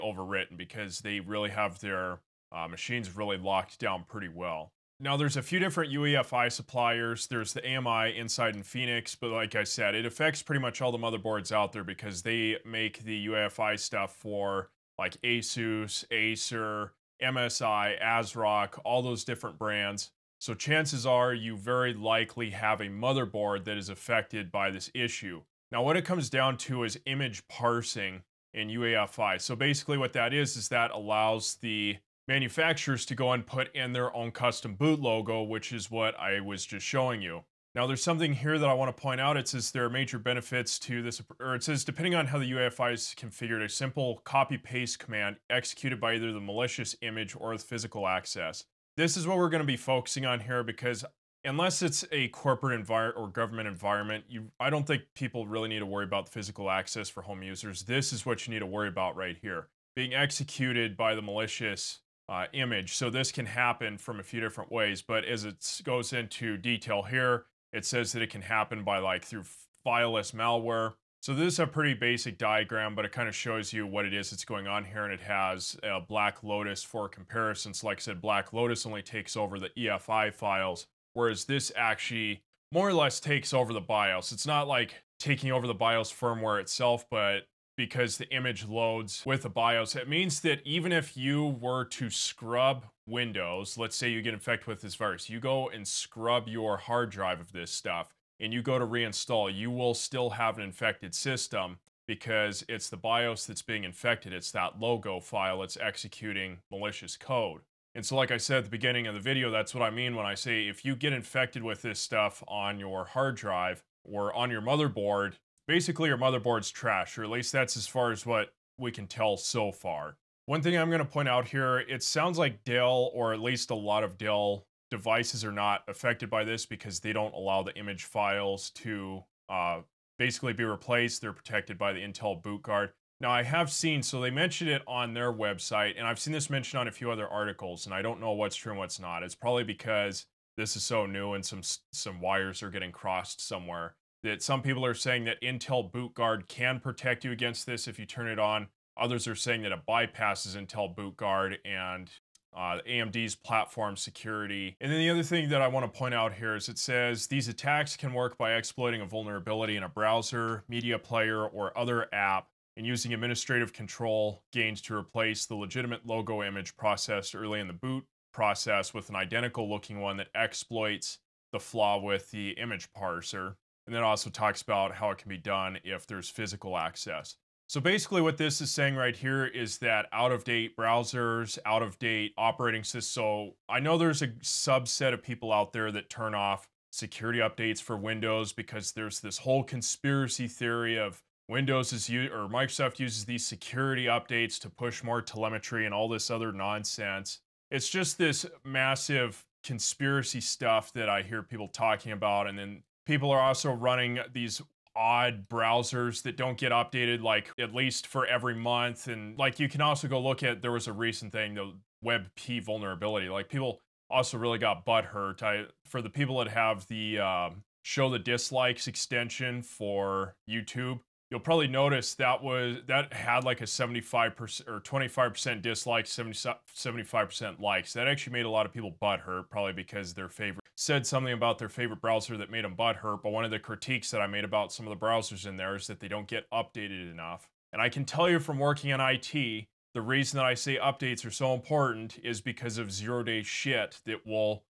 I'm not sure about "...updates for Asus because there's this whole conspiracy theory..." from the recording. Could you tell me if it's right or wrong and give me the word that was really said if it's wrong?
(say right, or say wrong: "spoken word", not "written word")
wrong: "Windows", not "Asus".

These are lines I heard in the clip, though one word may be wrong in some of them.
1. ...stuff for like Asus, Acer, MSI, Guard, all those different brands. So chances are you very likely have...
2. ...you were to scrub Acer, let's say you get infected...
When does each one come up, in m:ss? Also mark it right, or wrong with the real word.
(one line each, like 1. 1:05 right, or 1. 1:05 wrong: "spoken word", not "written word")
1. 0:13 wrong: "ASRock", not "Guard"
2. 1:31 wrong: "Windows", not "Acer".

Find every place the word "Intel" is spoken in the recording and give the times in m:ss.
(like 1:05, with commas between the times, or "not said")
2:11, 2:25, 2:30.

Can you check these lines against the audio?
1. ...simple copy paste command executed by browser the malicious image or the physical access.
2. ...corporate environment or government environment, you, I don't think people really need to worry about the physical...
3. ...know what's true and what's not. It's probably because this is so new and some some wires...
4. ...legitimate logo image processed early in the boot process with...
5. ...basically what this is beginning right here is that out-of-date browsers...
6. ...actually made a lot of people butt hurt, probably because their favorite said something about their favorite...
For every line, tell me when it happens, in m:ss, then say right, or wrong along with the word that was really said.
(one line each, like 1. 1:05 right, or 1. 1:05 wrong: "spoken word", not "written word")
1. 0:43 wrong: "either", not "browser"
2. 0:52 right
3. 2:18 right
4. 2:45 right
5. 2:57 wrong: "saying", not "beginning"
6. 3:48 right.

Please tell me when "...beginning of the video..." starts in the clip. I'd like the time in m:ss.
1:48.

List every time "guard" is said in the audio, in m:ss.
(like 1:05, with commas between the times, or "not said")
2:12, 2:26, 2:31.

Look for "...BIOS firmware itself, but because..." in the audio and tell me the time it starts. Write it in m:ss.
1:25.